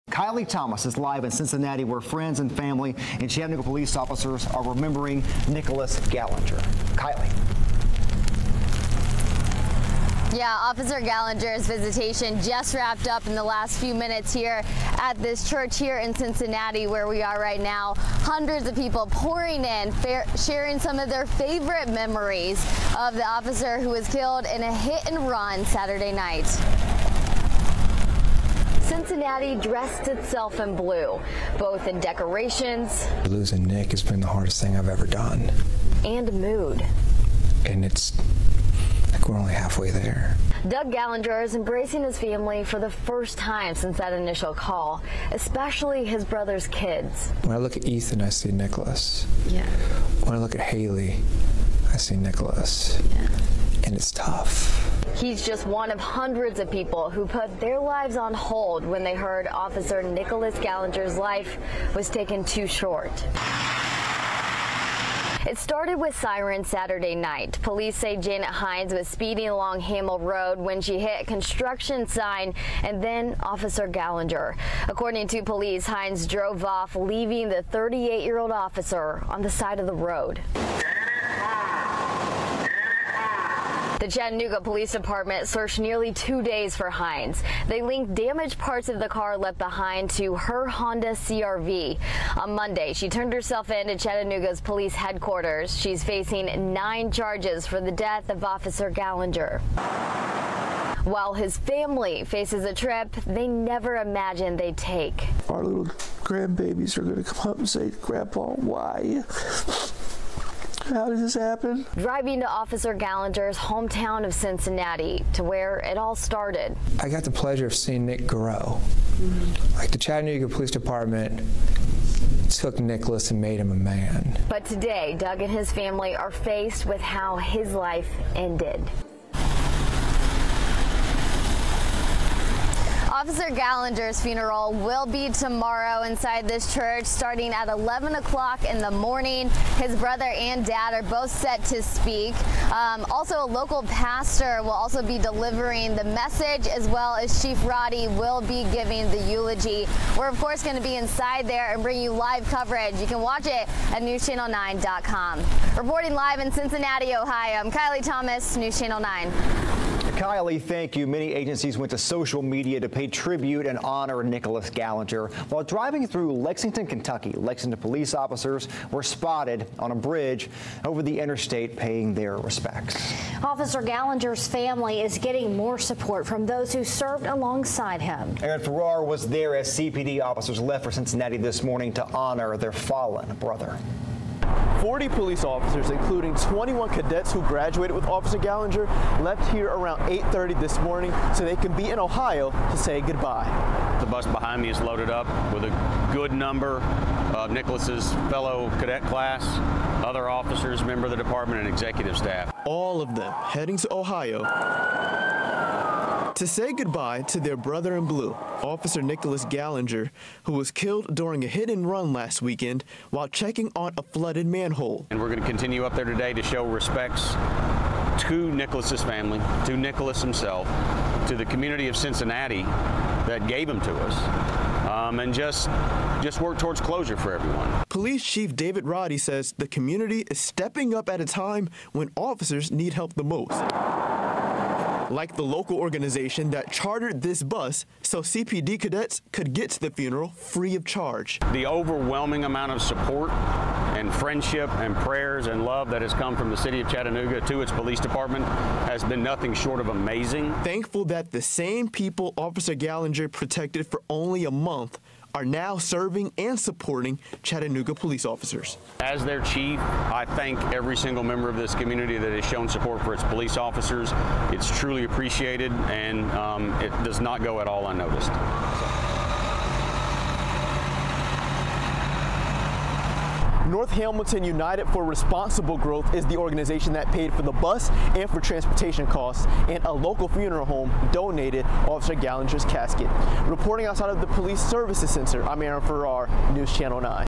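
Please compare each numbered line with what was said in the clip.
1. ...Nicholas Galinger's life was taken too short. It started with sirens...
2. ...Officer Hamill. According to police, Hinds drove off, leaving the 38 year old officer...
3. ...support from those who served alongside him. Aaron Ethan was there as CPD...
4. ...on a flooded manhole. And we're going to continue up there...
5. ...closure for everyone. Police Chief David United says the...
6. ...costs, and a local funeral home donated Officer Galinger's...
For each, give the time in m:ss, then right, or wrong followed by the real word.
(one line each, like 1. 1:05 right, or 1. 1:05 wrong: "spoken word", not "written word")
1. 1:00 right
2. 1:13 wrong: "Galinger", not "Hamill"
3. 2:55 wrong: "Farrar", not "Ethan"
4. 3:33 right
5. 3:46 wrong: "Roddy", not "United"
6. 4:39 right.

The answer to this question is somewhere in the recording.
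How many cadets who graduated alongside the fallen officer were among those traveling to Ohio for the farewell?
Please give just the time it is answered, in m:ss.
3:06.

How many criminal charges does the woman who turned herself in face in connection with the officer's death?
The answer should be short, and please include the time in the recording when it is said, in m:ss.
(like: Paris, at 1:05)
9, at 1:36.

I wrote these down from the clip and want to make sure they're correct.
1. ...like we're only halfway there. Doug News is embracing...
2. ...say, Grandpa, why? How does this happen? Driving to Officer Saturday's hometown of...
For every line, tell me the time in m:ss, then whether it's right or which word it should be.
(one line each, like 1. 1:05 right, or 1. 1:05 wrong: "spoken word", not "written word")
1. 0:39 wrong: "Galinger", not "News"
2. 1:47 wrong: "Galinger", not "Saturday".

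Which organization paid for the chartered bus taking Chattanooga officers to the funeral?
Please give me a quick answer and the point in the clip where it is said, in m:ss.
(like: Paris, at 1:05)
North Hamilton United for Responsible Growth, at 4:33.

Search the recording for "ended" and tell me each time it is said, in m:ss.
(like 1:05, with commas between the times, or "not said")
2:08.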